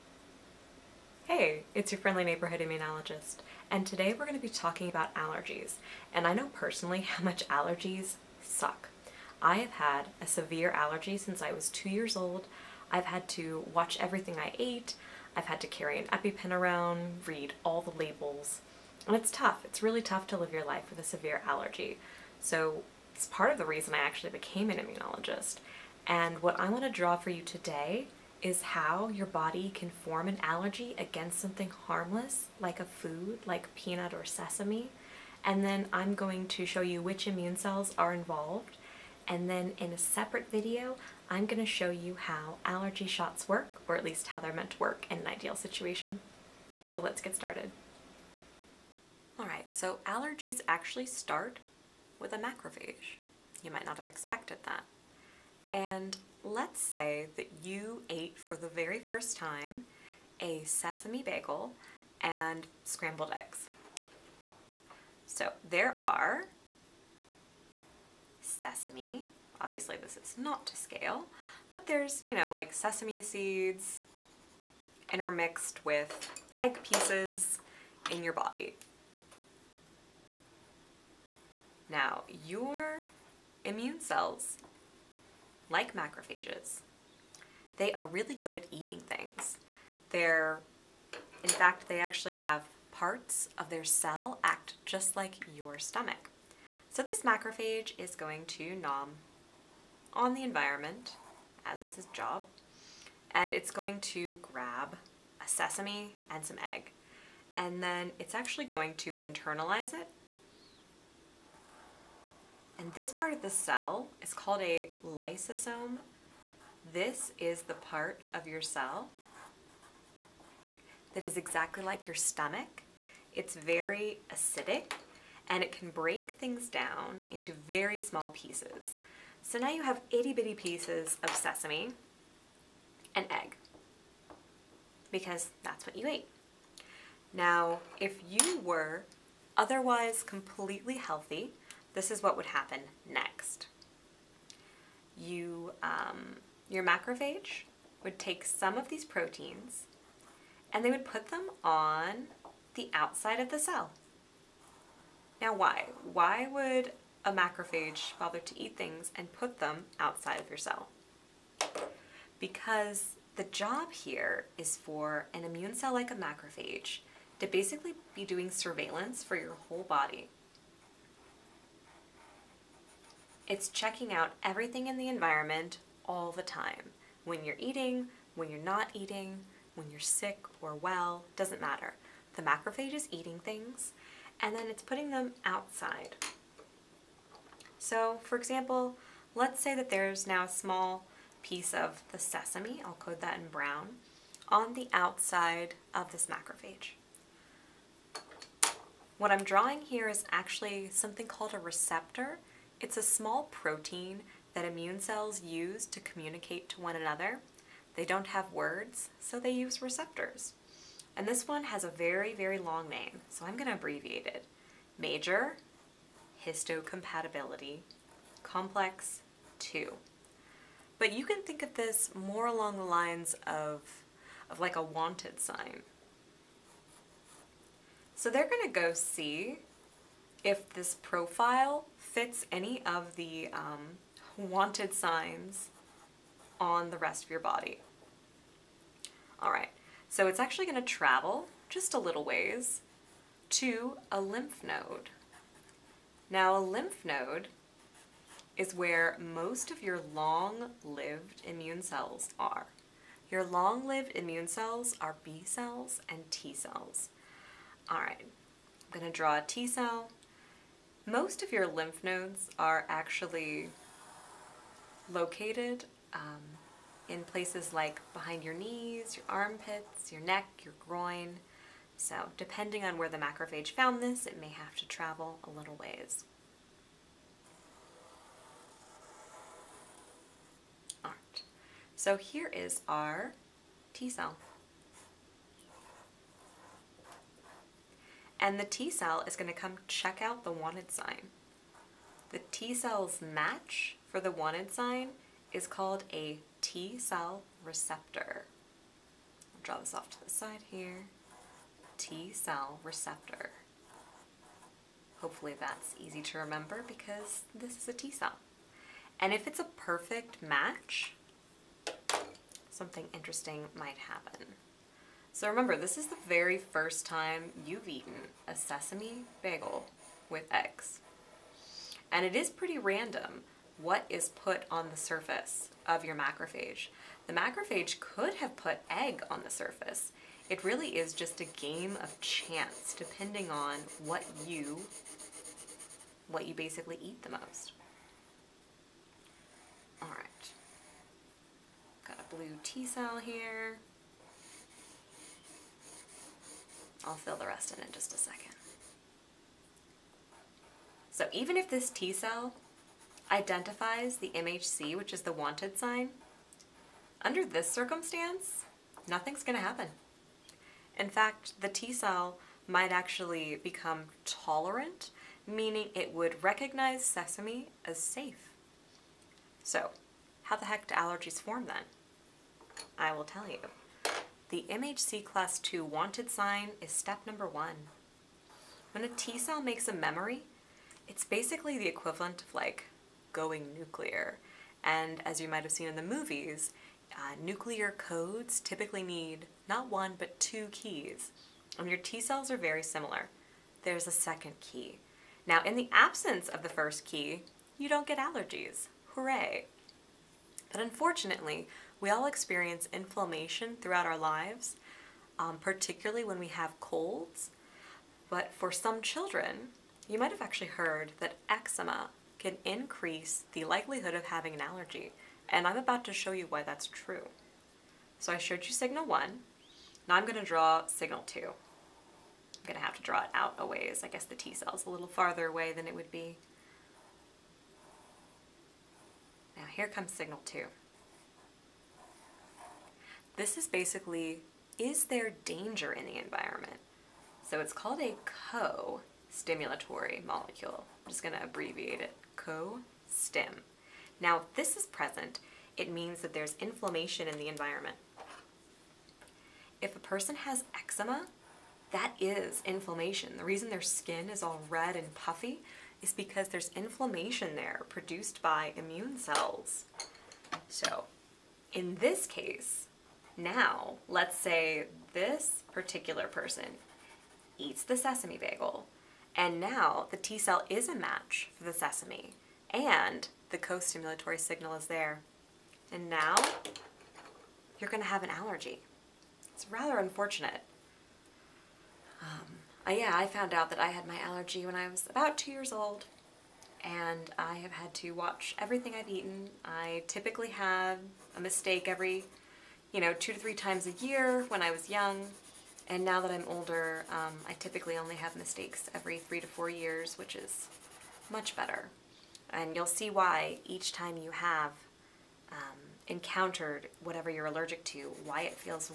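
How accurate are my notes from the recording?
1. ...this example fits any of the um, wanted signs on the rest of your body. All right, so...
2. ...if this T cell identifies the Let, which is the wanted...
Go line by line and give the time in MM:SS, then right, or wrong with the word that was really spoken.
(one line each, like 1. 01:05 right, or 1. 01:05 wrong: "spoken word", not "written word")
1. 03:50 wrong: "profile", not "example"
2. 05:51 wrong: "MHC", not "Let".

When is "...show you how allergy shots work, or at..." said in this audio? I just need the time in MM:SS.
00:41.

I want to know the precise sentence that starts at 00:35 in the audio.
And then I'm going to show you which immune cells are involved.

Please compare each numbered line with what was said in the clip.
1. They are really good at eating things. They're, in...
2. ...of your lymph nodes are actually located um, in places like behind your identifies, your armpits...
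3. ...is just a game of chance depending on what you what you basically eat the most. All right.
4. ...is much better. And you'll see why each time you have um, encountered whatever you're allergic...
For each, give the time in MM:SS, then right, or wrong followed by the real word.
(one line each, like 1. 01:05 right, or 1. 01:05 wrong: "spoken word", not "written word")
1. 01:27 right
2. 04:21 wrong: "knees", not "identifies"
3. 05:30 right
4. 08:20 right.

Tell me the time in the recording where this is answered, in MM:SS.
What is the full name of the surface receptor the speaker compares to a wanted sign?
03:34.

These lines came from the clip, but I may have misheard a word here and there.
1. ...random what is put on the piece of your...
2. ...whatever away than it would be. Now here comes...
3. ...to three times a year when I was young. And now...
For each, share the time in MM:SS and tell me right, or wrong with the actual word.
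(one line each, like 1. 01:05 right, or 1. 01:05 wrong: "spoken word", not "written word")
1. 05:22 wrong: "surface", not "piece"
2. 07:05 wrong: "farther", not "whatever"
3. 08:13 right.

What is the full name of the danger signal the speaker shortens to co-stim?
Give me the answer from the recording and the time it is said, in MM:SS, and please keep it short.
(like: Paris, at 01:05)
Co-stimulatory molecule, at 07:18.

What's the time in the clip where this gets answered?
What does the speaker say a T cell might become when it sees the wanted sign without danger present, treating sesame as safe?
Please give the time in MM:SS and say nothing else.
06:04.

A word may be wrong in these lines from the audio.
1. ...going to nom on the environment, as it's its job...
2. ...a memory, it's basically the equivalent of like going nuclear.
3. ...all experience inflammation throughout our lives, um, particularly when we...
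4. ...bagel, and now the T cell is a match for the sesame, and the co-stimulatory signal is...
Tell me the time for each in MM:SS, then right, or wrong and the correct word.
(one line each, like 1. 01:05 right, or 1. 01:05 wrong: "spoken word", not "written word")
1. 01:38 right
2. 06:19 right
3. 06:42 right
4. 07:48 right.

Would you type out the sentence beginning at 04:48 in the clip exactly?
and the T cell is going to come check out the wanted sign.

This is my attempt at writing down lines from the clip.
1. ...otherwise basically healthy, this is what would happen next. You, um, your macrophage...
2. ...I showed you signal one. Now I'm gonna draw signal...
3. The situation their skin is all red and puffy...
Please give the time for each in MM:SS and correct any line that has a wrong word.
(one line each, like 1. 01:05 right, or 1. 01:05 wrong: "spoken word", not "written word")
1. 02:19 wrong: "completely", not "basically"
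2. 06:58 right
3. 07:33 wrong: "reason", not "situation".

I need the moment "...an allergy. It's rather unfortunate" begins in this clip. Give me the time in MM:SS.
07:58.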